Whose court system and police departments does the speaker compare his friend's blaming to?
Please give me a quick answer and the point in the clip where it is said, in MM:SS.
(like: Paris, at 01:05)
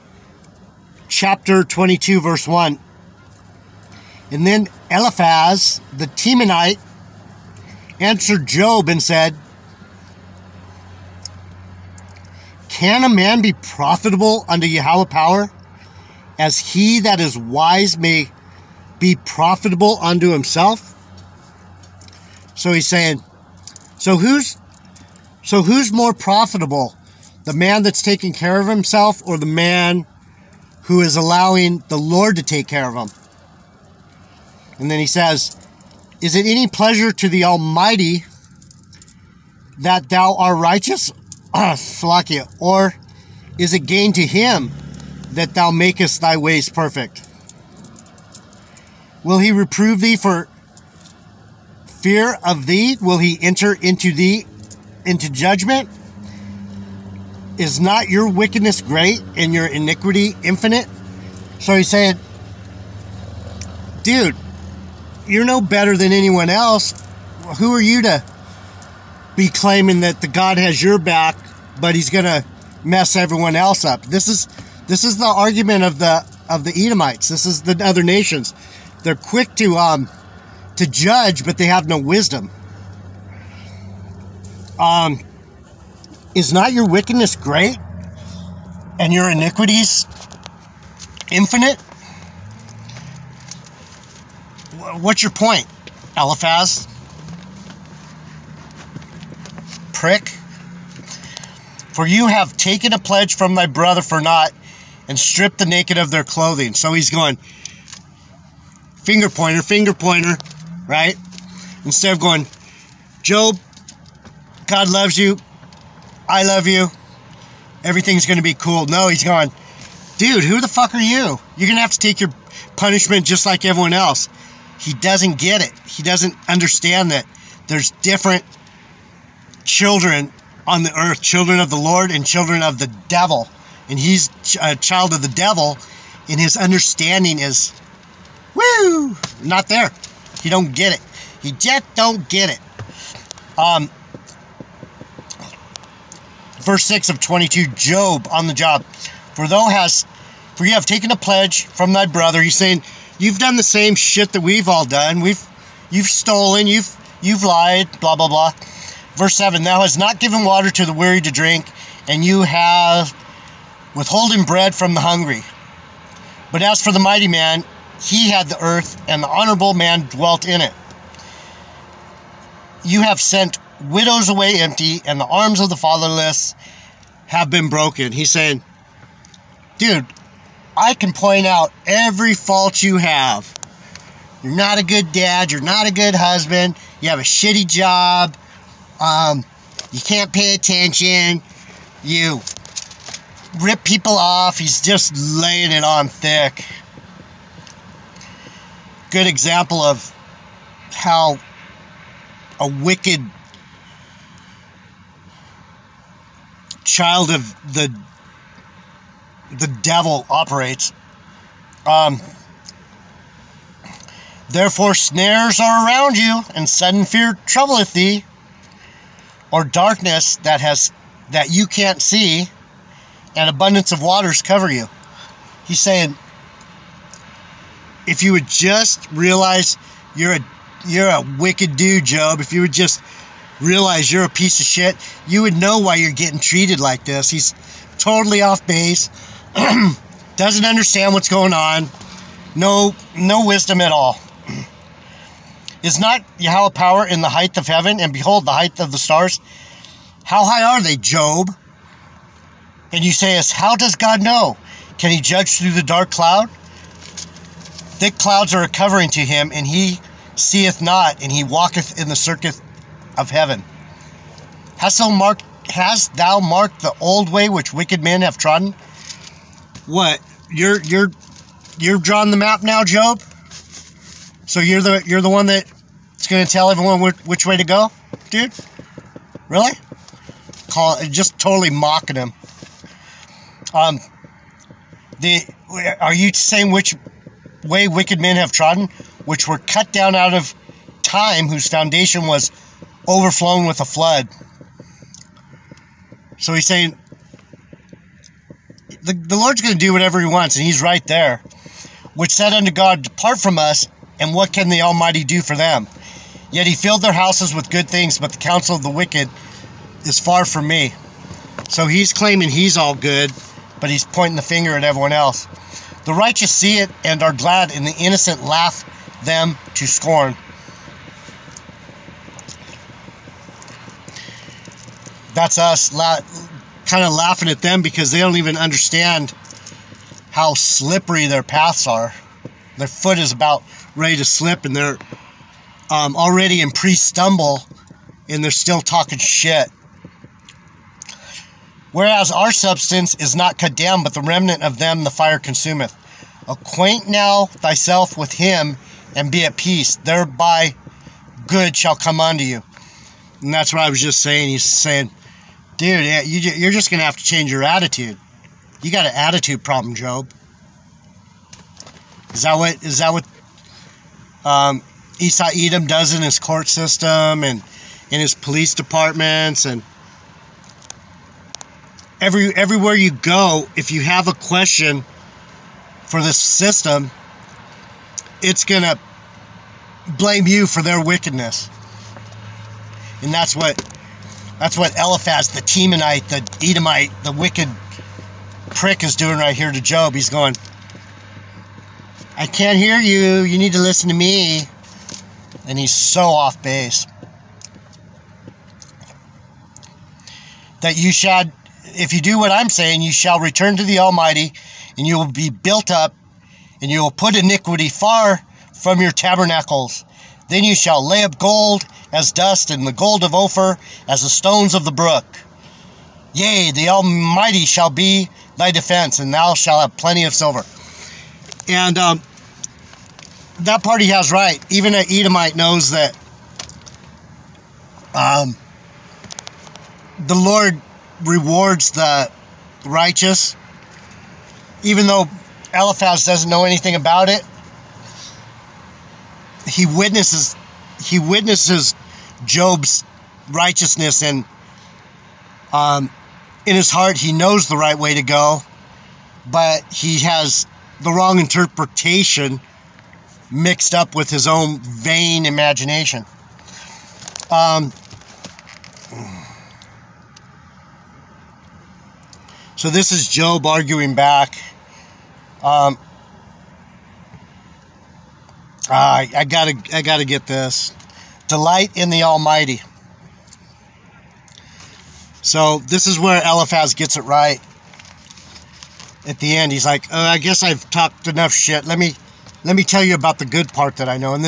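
Esau Edom, at 06:05.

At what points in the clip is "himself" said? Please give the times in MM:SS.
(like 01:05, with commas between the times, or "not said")
00:20, 00:28.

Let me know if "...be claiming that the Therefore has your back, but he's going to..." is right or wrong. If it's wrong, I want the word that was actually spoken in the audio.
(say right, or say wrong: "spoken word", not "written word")
wrong: "God", not "Therefore".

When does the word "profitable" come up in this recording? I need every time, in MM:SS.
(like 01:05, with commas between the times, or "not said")
00:13, 00:19, 00:26.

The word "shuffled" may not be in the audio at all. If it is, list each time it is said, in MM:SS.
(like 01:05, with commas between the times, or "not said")
not said.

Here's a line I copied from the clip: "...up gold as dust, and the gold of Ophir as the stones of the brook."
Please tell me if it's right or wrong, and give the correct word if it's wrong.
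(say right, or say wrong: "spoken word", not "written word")
right.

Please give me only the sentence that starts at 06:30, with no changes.
He's going, I can't hear you.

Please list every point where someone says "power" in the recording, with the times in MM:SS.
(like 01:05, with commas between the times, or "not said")
00:15, 04:06.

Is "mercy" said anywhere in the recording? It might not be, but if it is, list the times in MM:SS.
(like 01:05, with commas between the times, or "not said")
not said.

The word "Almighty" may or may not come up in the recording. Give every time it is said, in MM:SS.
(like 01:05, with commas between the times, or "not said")
00:37, 05:04, 06:43, 06:56, 07:52.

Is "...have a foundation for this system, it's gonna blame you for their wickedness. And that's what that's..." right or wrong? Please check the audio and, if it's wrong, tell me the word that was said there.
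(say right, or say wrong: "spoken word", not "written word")
wrong: "question", not "foundation".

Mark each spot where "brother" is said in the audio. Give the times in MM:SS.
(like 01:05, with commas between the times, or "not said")
01:43, 02:32.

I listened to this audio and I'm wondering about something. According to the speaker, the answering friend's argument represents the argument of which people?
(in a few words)
Edomites.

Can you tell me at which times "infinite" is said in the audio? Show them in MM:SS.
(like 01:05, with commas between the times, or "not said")
01:00, 01:31.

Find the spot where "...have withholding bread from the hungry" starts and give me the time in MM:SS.
02:42.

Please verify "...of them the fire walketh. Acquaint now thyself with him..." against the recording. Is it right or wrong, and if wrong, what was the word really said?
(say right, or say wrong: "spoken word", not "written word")
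wrong: "consumeth", not "walketh".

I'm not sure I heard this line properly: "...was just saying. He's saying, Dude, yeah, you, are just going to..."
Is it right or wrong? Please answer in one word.
right.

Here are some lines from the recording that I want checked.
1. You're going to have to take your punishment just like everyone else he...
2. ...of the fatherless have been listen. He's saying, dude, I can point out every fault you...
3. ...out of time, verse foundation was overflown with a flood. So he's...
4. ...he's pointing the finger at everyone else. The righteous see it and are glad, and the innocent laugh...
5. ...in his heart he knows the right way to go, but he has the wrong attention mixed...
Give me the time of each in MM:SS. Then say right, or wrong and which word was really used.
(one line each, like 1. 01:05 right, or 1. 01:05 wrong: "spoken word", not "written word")
1. 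02:01 right
2. 02:55 wrong: "broken", not "listen"
3. 04:50 wrong: "whose", not "verse"
4. 05:13 right
5. 07:26 wrong: "interpretation", not "attention".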